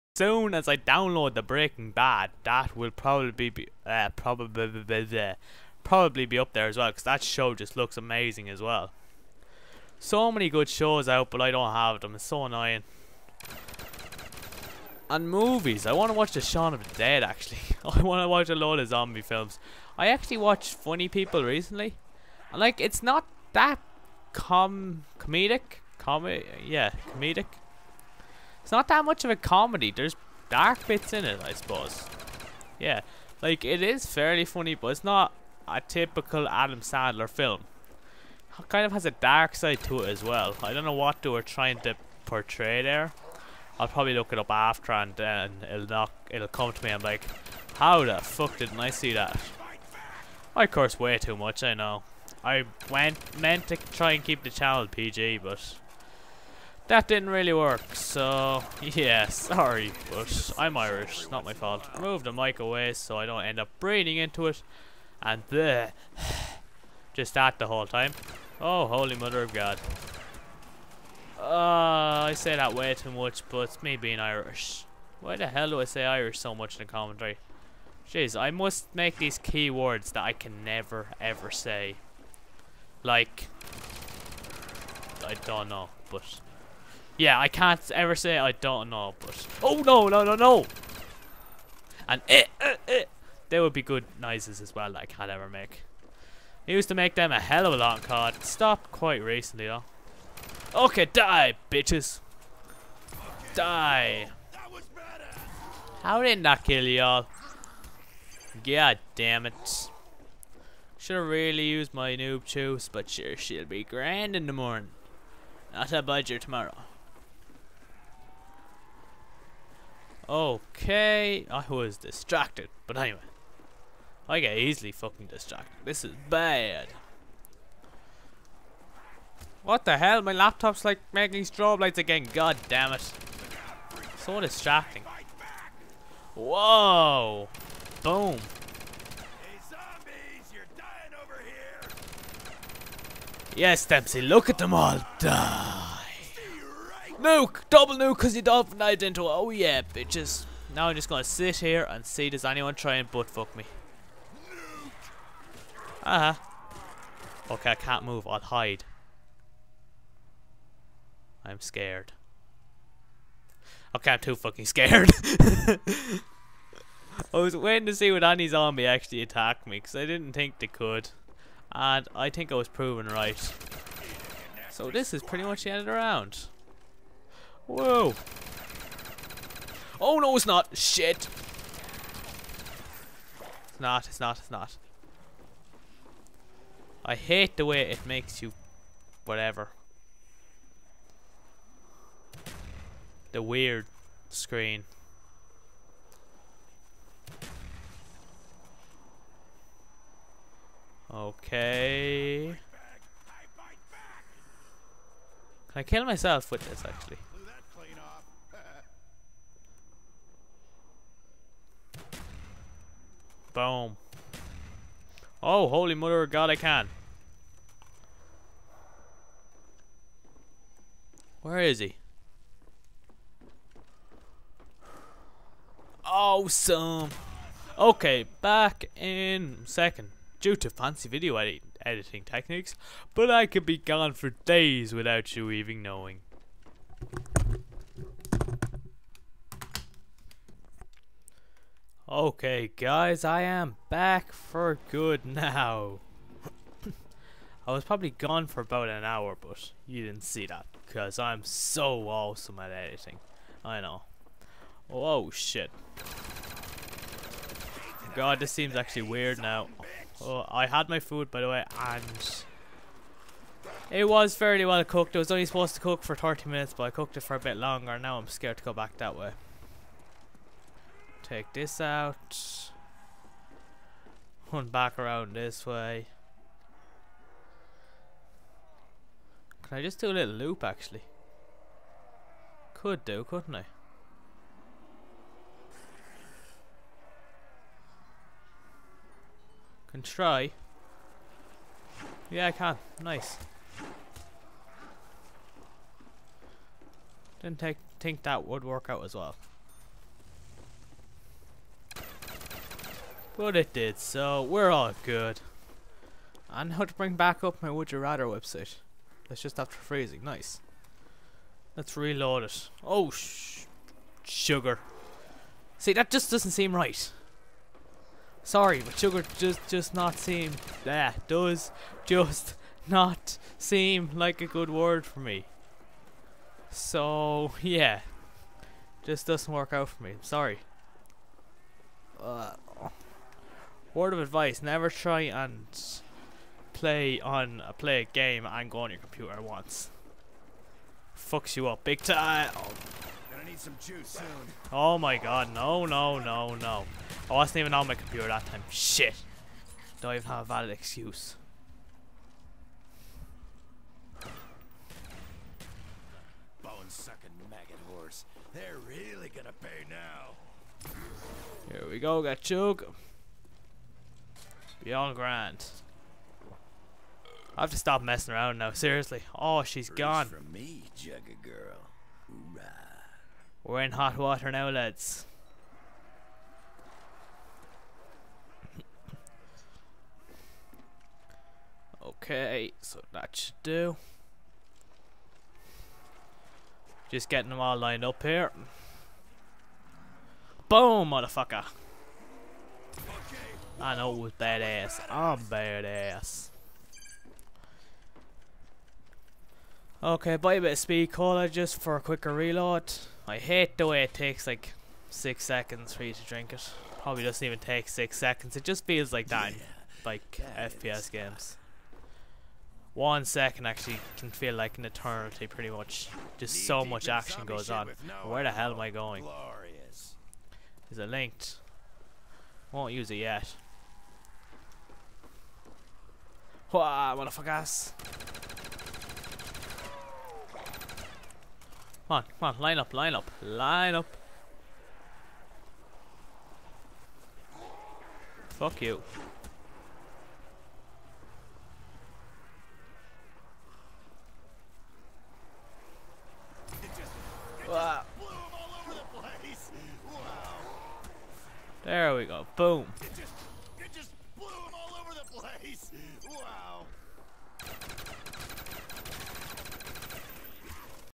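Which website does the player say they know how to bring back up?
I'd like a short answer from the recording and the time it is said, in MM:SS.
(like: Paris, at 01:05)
Would You Rather, at 05:07.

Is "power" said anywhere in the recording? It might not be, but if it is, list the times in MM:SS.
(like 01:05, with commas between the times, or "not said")
not said.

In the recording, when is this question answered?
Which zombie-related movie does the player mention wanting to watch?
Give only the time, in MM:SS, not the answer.
00:16.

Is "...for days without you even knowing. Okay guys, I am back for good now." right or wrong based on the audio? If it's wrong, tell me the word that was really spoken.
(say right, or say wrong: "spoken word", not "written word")
right.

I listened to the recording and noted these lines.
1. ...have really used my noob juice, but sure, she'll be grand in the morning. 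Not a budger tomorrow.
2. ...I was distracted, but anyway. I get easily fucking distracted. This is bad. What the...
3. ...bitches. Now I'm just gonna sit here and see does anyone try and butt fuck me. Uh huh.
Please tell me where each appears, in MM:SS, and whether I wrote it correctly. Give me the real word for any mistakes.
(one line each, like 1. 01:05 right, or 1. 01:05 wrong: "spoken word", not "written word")
1. 01:51 right
2. 02:01 right
3. 02:29 right.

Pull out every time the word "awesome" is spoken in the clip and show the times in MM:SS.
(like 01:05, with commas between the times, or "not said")
03:46, 04:12.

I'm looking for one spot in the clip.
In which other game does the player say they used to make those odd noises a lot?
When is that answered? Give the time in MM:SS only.
01:38.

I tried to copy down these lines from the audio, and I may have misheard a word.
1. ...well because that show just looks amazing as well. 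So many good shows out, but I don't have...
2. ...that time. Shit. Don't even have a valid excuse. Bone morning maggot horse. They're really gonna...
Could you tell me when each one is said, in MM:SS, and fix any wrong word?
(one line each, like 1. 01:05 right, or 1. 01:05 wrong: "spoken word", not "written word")
1. 00:06 right
2. 05:48 wrong: "sucking", not "morning".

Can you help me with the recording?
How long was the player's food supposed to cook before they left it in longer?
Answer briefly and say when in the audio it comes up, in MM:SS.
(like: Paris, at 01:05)
30 minutes, at 04:26.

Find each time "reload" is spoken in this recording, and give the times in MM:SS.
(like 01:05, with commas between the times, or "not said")
05:11, 06:42.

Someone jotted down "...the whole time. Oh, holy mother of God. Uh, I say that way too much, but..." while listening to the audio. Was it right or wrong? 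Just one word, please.
right.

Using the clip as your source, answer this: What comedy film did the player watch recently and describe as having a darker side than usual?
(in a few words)
Funny People.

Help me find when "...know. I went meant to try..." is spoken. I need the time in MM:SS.
00:51.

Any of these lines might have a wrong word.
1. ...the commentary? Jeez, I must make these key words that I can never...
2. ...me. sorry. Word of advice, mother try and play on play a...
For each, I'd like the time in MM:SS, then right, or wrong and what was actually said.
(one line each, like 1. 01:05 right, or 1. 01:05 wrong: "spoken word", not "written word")
1. 01:16 right
2. 05:30 wrong: "never", not "mother".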